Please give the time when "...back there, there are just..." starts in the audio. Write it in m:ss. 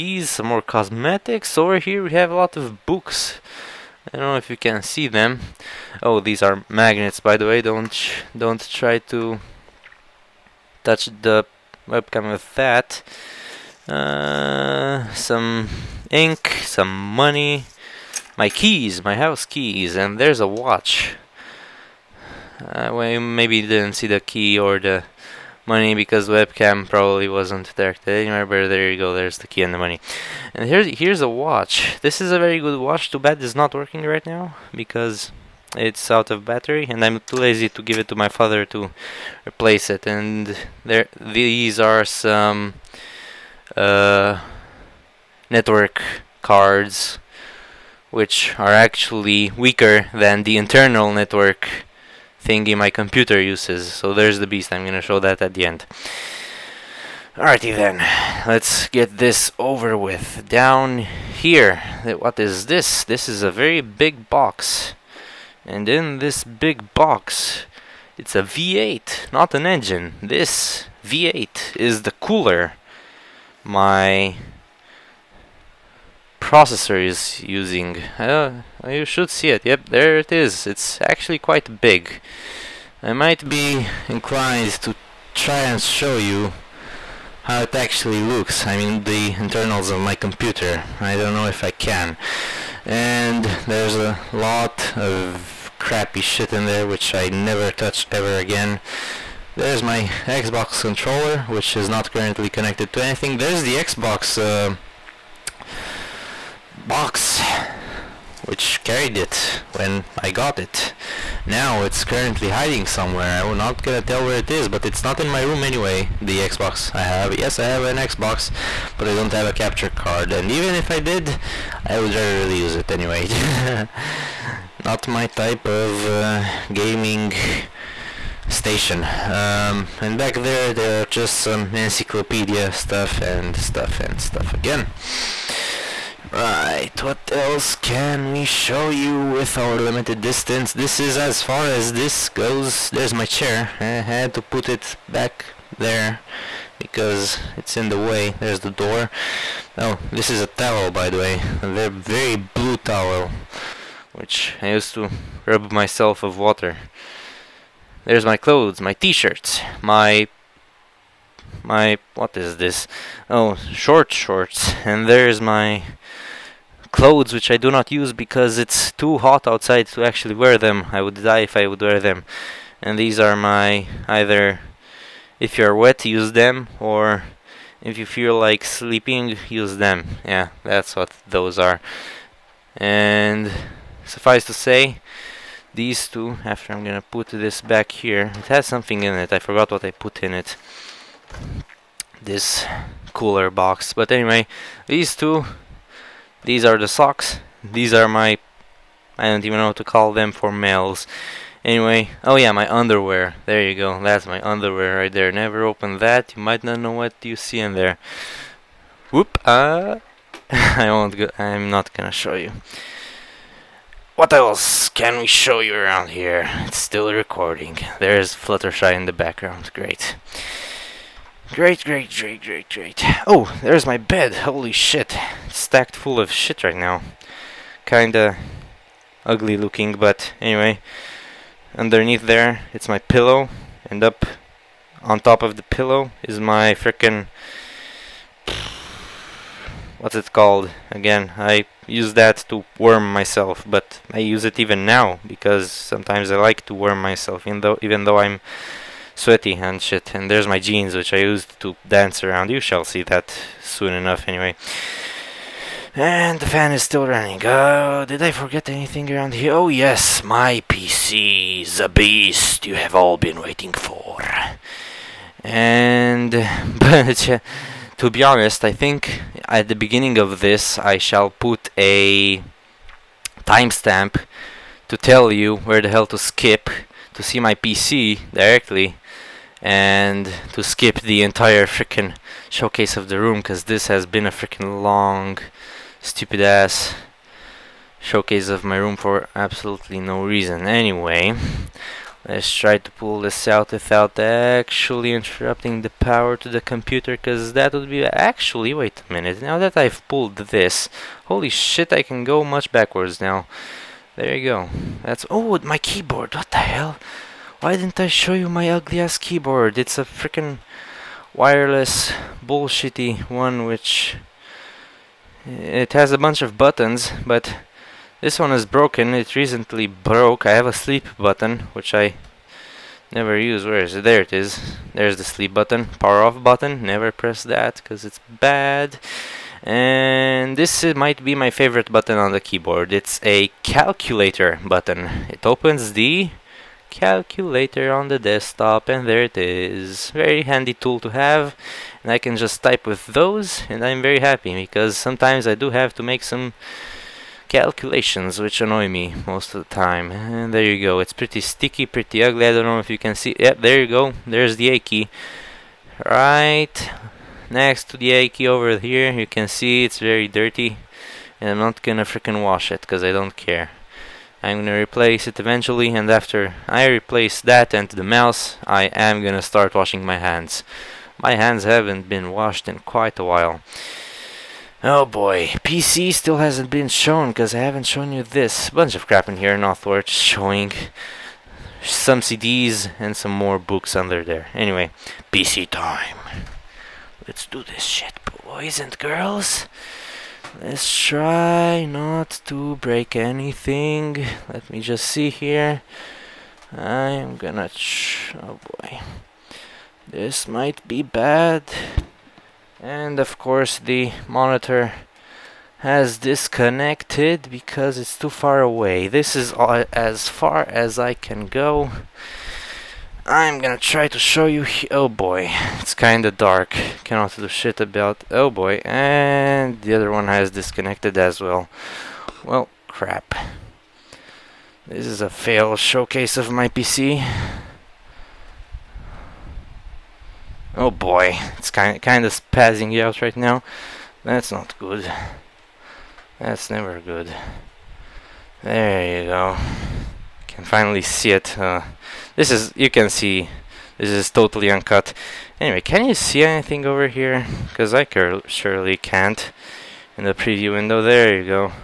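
2:10.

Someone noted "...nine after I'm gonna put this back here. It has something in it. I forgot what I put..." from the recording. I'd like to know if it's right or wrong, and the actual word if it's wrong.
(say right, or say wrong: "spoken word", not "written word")
wrong: "two", not "nine".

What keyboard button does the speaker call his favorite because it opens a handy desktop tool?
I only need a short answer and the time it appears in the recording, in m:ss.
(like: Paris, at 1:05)
calculator button, at 5:33.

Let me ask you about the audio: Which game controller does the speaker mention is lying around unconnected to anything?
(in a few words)
Xbox controller.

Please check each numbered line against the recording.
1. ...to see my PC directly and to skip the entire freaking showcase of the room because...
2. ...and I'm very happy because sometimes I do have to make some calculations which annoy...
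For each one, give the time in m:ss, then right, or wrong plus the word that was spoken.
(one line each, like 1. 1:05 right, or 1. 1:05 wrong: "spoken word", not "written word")
1. 4:37 right
2. 5:43 right.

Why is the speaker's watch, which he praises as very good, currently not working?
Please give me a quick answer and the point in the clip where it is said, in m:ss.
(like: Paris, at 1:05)
out of battery, at 0:36.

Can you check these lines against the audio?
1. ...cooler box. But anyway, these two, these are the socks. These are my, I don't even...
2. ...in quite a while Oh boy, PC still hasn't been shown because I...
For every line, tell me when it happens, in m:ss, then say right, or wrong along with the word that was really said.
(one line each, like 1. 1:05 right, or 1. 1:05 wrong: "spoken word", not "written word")
1. 3:13 right
2. 6:12 right.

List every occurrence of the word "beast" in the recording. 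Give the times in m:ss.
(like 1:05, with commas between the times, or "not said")
0:54, 4:21.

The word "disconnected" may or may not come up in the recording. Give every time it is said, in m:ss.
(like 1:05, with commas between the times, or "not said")
6:46, 7:00.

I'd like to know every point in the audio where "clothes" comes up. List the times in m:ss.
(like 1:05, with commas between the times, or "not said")
2:38, 2:46.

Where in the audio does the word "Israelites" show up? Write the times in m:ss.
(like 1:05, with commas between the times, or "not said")
not said.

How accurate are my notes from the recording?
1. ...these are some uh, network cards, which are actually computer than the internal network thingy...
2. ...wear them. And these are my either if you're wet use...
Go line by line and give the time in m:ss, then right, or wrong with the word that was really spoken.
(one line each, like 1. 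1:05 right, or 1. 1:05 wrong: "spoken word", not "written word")
1. 0:41 wrong: "weaker", not "computer"
2. 2:51 right.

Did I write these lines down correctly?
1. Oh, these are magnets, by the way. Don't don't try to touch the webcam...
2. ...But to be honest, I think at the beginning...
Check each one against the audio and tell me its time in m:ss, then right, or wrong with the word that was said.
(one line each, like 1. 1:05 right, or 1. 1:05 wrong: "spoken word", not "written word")
1. 0:06 right
2. 4:26 right.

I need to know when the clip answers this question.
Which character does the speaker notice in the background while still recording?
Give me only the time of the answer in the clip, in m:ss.
3:38.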